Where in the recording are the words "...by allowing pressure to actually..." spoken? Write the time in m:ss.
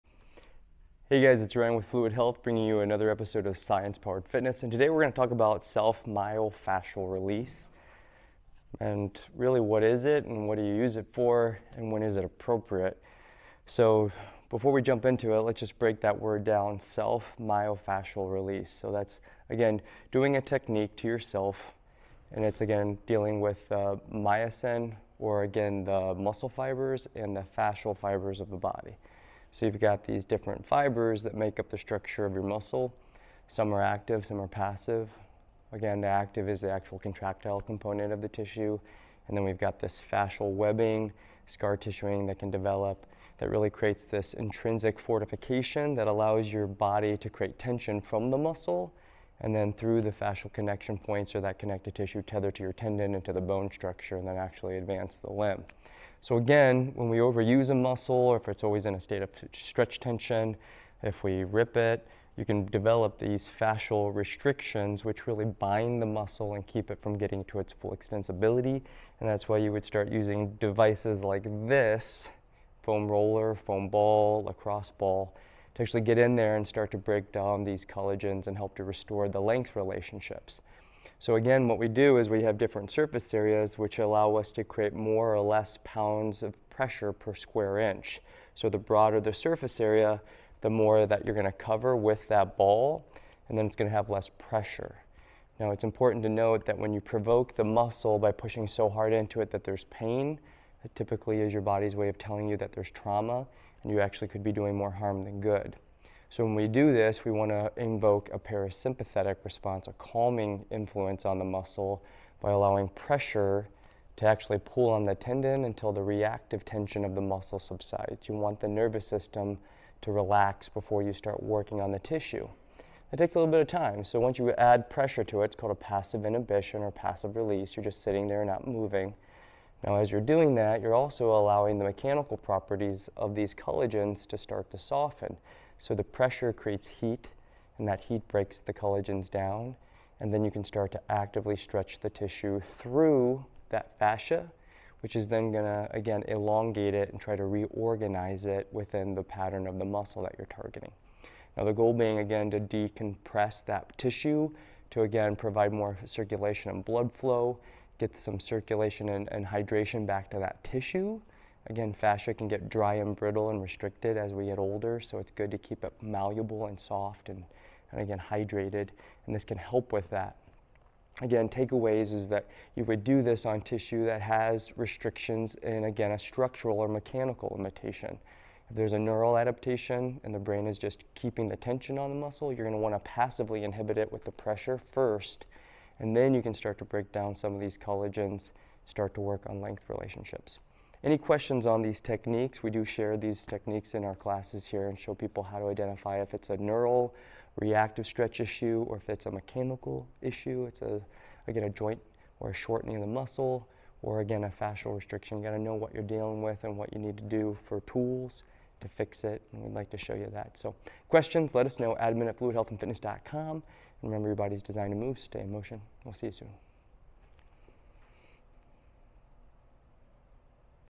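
1:52.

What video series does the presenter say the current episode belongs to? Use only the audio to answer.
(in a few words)
Science Powered Fitness.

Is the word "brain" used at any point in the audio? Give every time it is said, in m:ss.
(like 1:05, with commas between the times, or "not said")
3:00.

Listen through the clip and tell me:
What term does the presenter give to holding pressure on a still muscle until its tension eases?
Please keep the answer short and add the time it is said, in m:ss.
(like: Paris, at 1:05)
passive inhibition, at 2:05.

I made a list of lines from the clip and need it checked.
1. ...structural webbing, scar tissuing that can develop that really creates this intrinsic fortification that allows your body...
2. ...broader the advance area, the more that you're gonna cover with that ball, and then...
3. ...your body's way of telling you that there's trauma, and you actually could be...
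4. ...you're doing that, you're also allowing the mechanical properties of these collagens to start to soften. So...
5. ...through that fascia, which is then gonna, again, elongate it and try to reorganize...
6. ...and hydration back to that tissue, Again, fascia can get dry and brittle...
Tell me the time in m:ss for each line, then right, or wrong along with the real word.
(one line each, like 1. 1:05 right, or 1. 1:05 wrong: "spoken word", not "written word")
1. 0:40 wrong: "fascial", not "structural"
2. 1:28 wrong: "surface", not "advance"
3. 1:41 right
4. 2:10 right
5. 2:22 right
6. 2:39 right.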